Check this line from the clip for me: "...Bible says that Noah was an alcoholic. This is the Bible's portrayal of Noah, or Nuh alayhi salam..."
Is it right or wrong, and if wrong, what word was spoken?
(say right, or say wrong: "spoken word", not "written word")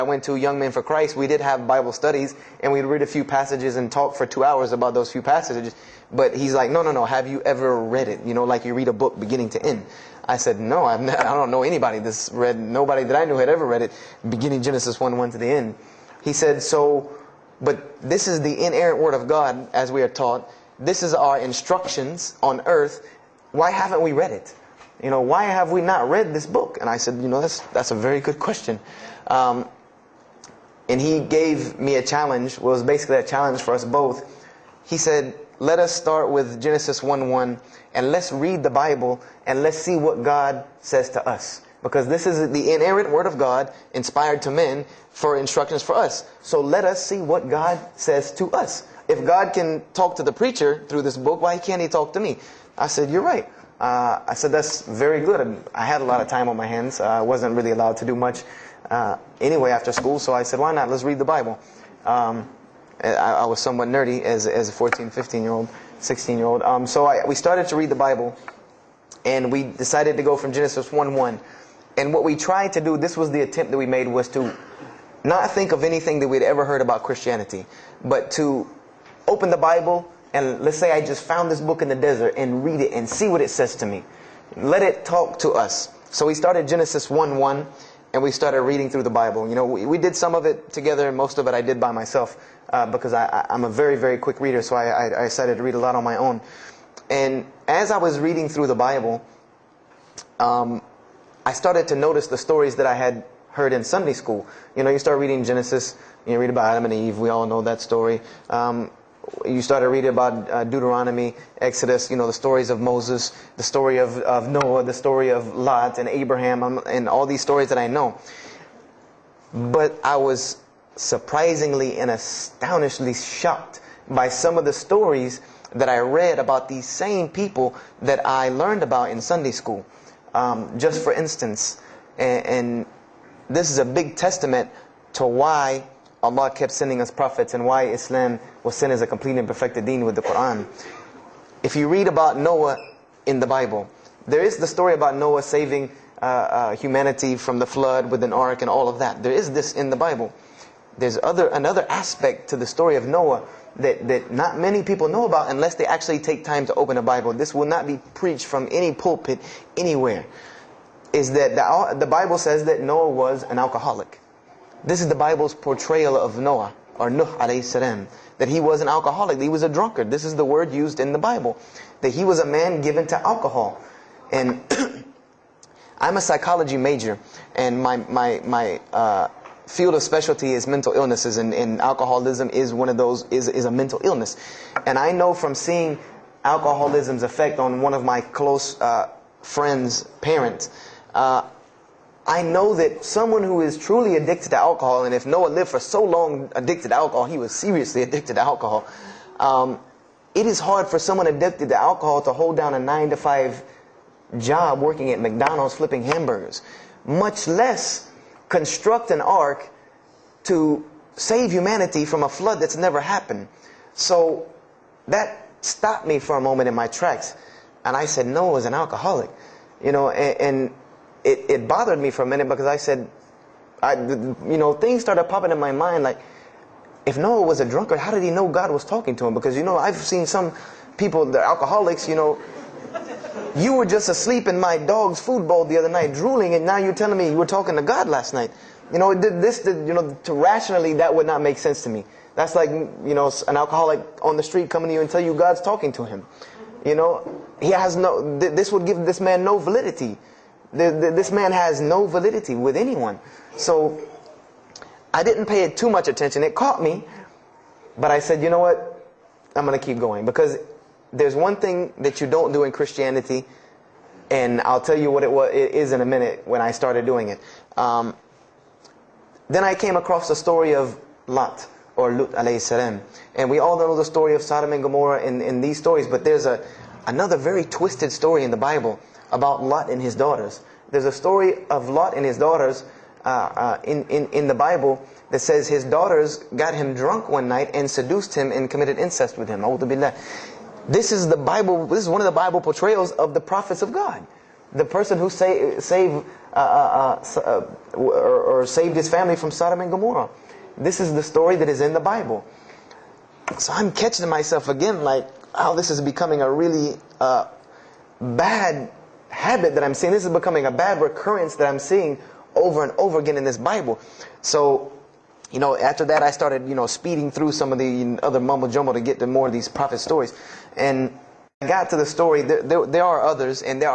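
right.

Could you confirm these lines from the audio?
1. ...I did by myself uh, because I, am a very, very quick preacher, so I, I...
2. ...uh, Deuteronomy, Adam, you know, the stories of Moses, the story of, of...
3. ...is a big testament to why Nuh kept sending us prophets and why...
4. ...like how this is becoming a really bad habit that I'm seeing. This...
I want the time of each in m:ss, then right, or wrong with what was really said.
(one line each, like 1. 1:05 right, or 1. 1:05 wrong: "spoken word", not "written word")
1. 1:31 wrong: "reader", not "preacher"
2. 1:50 wrong: "Exodus", not "Adam"
3. 2:13 wrong: "Allah", not "Nuh"
4. 5:05 right.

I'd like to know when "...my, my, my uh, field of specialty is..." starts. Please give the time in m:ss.
2:57.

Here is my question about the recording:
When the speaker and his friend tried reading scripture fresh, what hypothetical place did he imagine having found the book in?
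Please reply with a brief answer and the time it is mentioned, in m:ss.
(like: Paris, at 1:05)
the desert, at 1:21.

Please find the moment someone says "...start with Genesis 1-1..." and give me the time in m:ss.
0:35.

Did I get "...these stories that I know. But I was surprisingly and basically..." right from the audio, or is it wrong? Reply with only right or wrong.
wrong.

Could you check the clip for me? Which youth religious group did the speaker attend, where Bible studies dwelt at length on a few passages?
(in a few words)
Young Men for Christ.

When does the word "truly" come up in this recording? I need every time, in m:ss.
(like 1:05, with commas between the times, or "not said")
3:13.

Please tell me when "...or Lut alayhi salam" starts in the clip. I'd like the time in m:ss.
4:31.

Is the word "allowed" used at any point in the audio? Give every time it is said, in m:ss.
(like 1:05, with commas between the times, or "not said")
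0:57.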